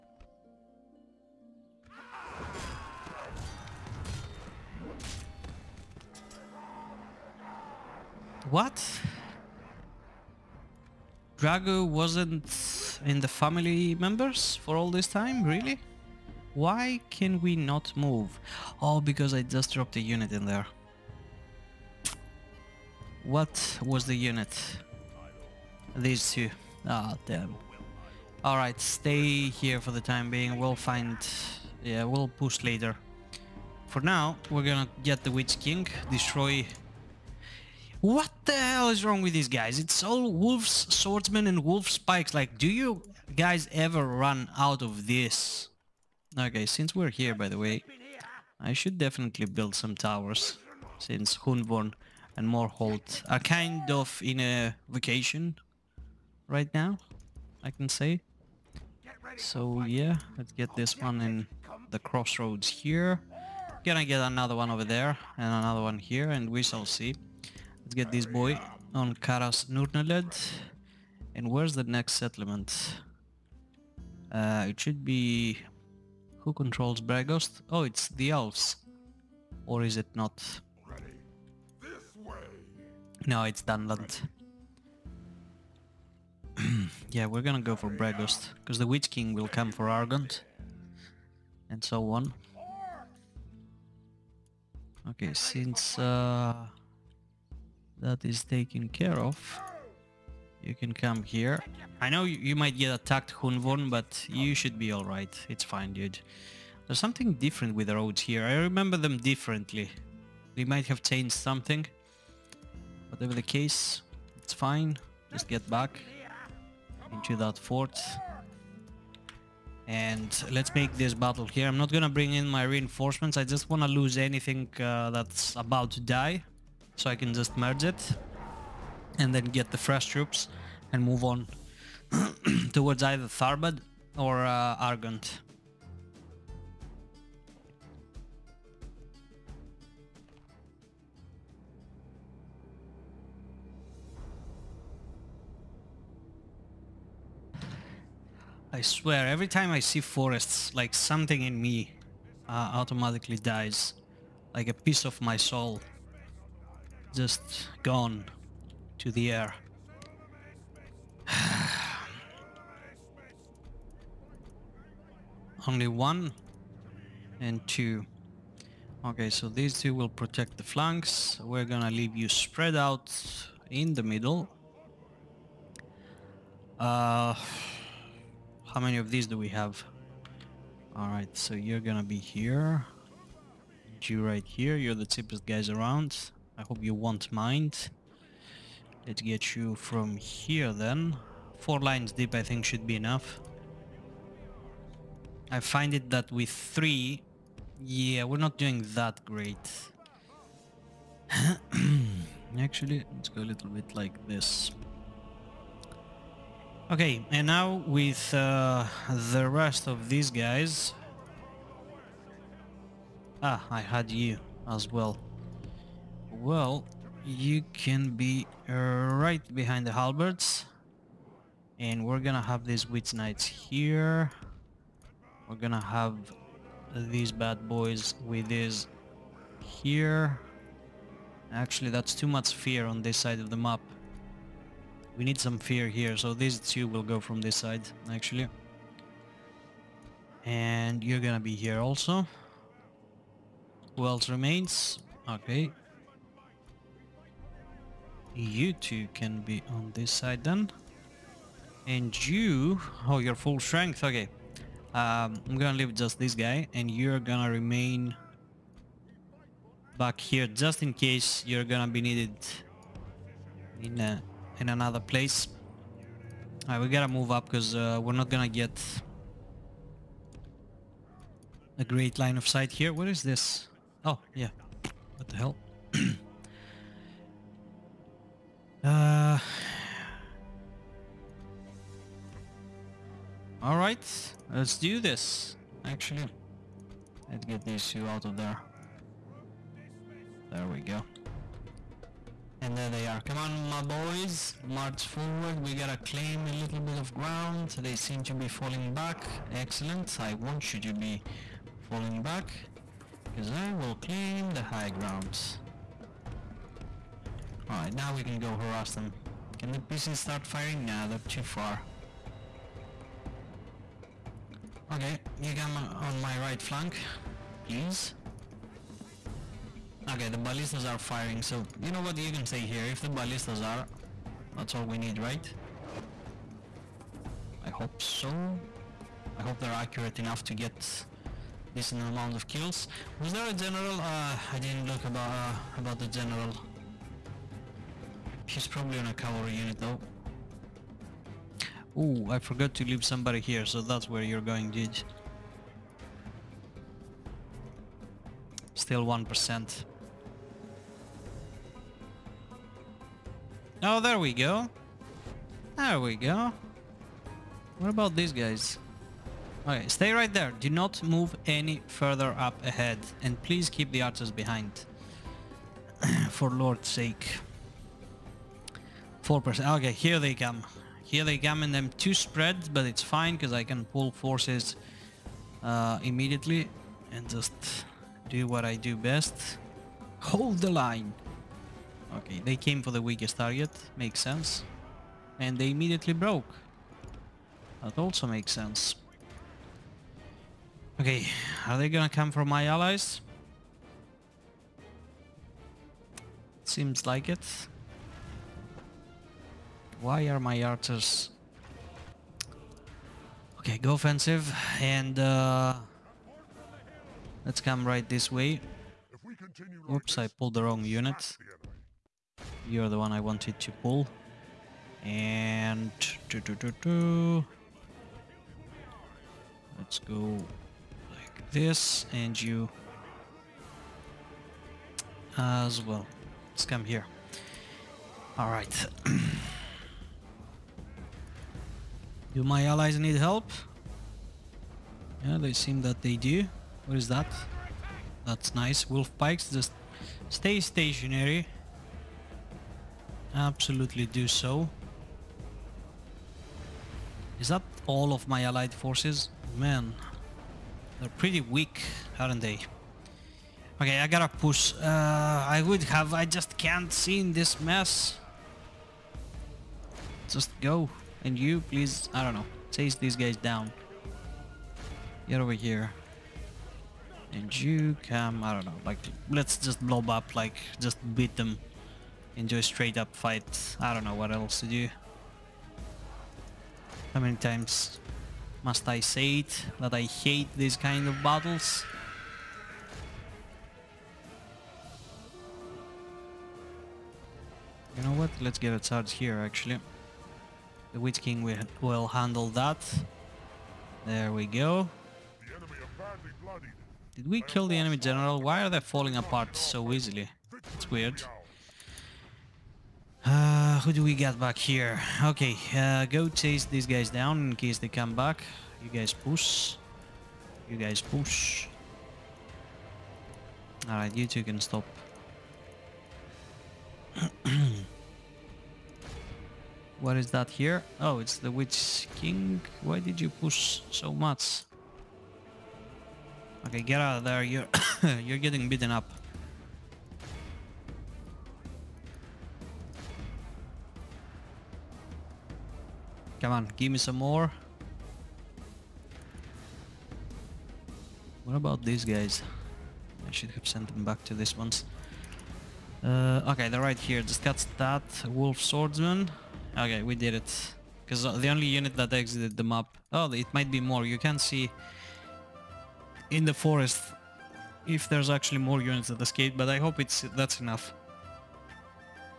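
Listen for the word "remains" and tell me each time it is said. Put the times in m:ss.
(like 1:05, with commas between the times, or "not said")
4:04, 4:17.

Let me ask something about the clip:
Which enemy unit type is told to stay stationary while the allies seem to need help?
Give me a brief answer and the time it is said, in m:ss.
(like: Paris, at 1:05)
Wolf pikes, at 7:18.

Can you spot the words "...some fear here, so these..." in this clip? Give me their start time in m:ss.
3:55.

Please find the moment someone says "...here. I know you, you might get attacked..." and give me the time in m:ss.
1:41.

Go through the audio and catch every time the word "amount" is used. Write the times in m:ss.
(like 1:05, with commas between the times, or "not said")
5:31.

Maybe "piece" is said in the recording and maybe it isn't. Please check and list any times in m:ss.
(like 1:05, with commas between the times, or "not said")
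2:34, 5:09.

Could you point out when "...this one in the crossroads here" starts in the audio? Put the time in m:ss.
1:00.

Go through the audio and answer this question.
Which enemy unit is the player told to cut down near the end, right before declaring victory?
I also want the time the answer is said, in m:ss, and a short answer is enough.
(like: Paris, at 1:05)
wolf swordsman, at 9:08.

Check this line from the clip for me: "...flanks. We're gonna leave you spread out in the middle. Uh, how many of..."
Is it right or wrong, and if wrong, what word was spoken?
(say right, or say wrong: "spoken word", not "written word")
right.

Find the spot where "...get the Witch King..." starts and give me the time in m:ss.
0:35.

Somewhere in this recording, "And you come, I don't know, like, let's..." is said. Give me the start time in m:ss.
7:47.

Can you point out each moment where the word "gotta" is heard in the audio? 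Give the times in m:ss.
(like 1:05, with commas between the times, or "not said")
4:26, 4:55, 7:34.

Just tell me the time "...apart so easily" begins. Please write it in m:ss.
8:19.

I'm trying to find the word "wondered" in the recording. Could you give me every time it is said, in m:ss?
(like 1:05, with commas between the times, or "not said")
not said.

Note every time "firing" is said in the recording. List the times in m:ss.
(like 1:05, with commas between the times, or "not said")
5:10, 5:20.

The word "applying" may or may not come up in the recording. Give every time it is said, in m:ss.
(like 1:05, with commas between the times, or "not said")
not said.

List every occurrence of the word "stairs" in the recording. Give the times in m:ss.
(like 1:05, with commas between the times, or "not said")
not said.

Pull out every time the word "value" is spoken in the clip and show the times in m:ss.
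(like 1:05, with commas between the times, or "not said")
not said.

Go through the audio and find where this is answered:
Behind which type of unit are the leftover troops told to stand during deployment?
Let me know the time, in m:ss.
3:39.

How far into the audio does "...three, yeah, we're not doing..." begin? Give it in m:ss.
3:16.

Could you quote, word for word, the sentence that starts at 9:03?
I should have sent them back to these ones.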